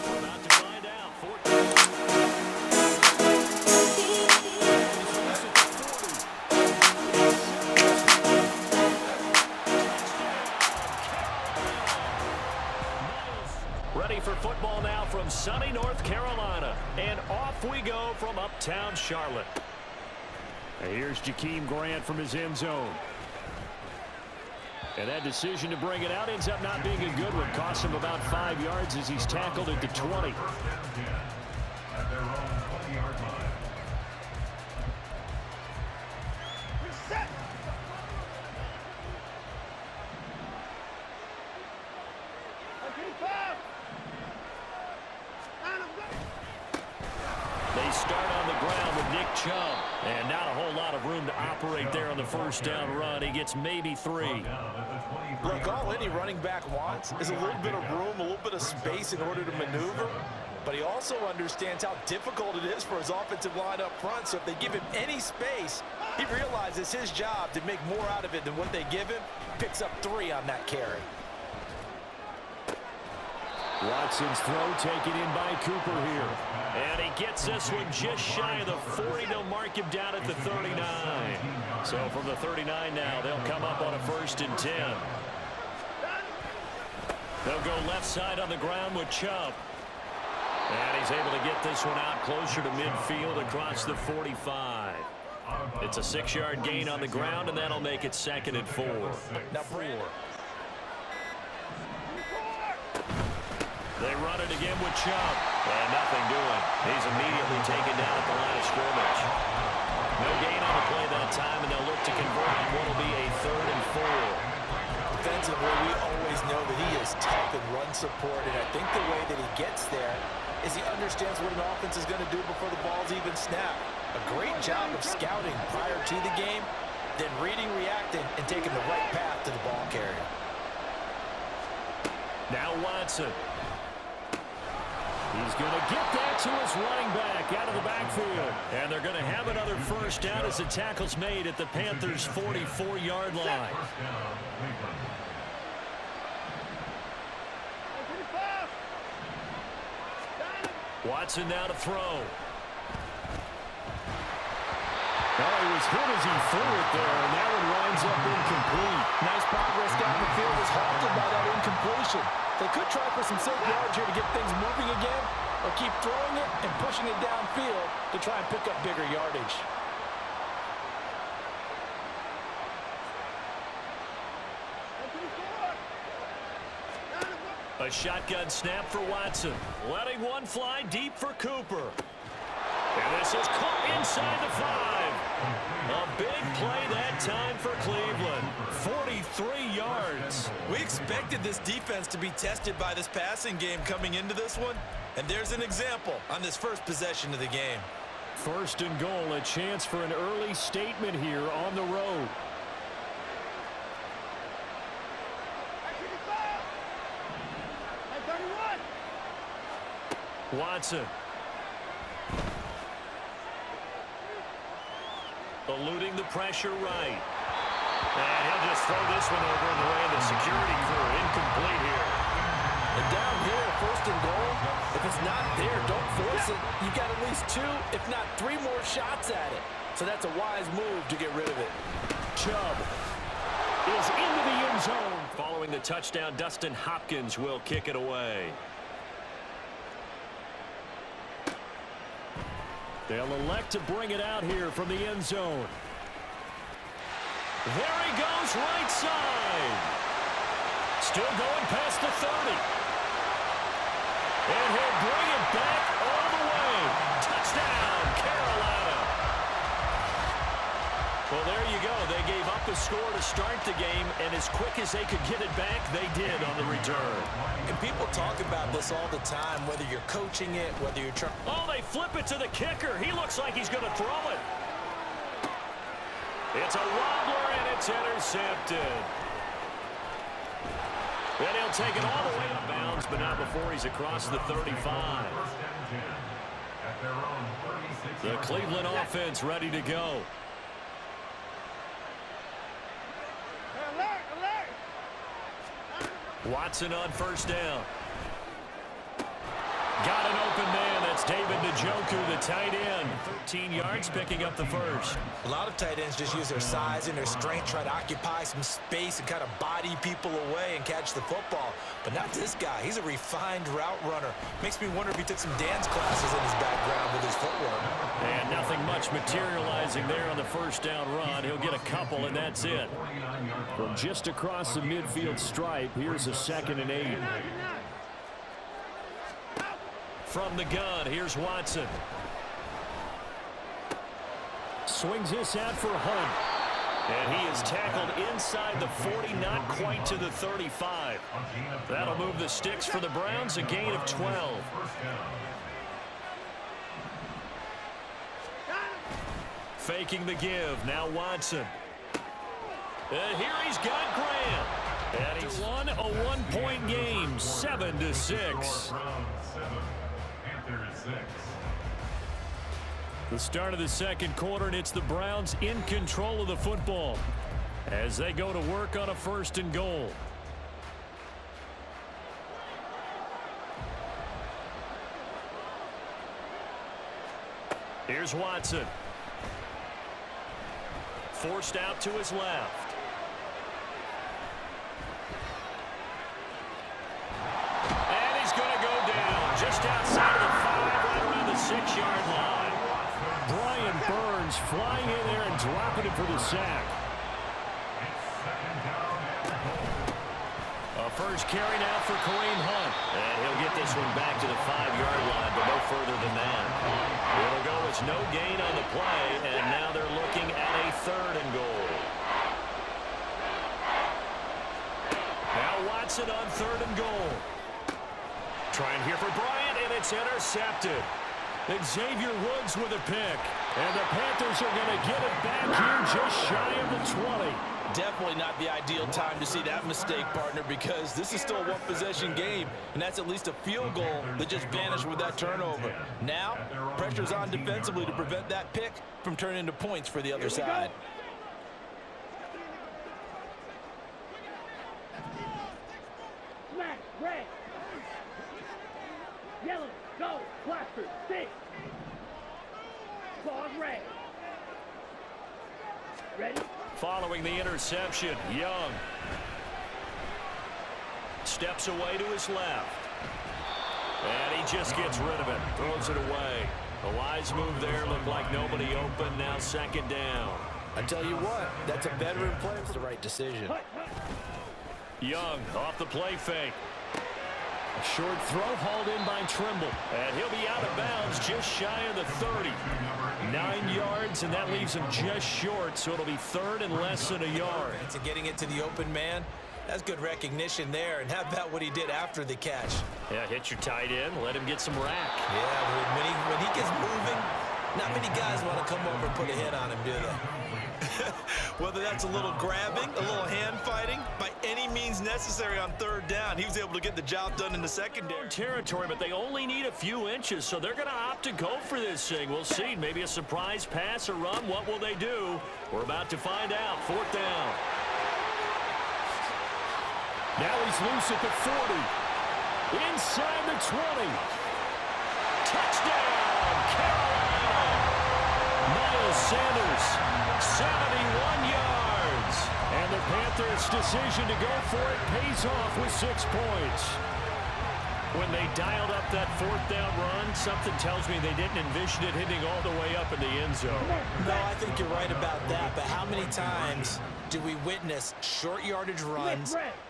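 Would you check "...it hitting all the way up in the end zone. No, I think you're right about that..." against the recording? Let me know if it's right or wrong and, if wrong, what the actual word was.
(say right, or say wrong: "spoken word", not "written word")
right.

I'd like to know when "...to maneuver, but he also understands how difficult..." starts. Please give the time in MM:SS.
00:59.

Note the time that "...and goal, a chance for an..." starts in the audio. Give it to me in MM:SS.
03:18.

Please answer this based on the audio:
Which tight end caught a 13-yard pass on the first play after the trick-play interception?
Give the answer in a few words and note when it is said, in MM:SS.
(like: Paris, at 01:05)
David Njoku, at 05:01.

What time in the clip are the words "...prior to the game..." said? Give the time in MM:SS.
02:05.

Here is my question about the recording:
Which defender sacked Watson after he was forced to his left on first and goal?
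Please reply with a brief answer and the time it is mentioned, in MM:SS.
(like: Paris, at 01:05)
Evans, at 06:34.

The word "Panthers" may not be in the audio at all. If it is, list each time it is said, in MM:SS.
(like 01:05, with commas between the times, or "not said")
02:21, 07:03, 08:53.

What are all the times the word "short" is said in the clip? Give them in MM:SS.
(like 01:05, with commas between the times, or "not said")
07:58, 08:05, 09:08.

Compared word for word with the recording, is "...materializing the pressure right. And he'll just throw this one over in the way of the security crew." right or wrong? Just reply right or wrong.
wrong.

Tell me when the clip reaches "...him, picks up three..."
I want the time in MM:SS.
01:09.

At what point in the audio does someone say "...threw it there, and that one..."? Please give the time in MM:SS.
02:36.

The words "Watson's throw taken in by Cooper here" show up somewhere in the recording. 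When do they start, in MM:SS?
01:13.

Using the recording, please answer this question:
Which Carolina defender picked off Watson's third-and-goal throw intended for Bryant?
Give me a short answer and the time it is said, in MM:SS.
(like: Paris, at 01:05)
Xavier Woods, at 07:01.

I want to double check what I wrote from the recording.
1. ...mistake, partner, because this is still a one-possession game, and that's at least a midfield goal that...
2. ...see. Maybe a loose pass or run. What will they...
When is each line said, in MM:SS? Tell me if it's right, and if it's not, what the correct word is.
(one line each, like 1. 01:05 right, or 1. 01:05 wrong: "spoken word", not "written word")
1. 07:09 wrong: "field", not "midfield"
2. 08:32 wrong: "surprise", not "loose".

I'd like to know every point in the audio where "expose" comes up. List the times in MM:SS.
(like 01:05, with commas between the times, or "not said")
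not said.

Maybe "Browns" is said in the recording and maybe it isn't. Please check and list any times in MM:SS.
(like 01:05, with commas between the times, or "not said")
05:43, 06:05.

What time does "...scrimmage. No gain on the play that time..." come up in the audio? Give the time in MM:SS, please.
01:48.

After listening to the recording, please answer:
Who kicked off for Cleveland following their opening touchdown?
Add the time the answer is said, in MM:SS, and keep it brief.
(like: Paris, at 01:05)
Dustin Hopkins, at 03:56.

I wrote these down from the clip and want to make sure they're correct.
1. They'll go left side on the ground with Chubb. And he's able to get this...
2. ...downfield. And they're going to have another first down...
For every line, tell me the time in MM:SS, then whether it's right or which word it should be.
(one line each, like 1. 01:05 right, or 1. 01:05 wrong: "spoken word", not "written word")
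1. 01:27 right
2. 02:17 wrong: "backfield", not "downfield".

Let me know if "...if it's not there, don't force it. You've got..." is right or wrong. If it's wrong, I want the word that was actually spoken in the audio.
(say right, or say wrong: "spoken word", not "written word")
right.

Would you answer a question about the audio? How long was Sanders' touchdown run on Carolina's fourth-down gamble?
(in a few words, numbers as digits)
71 yards.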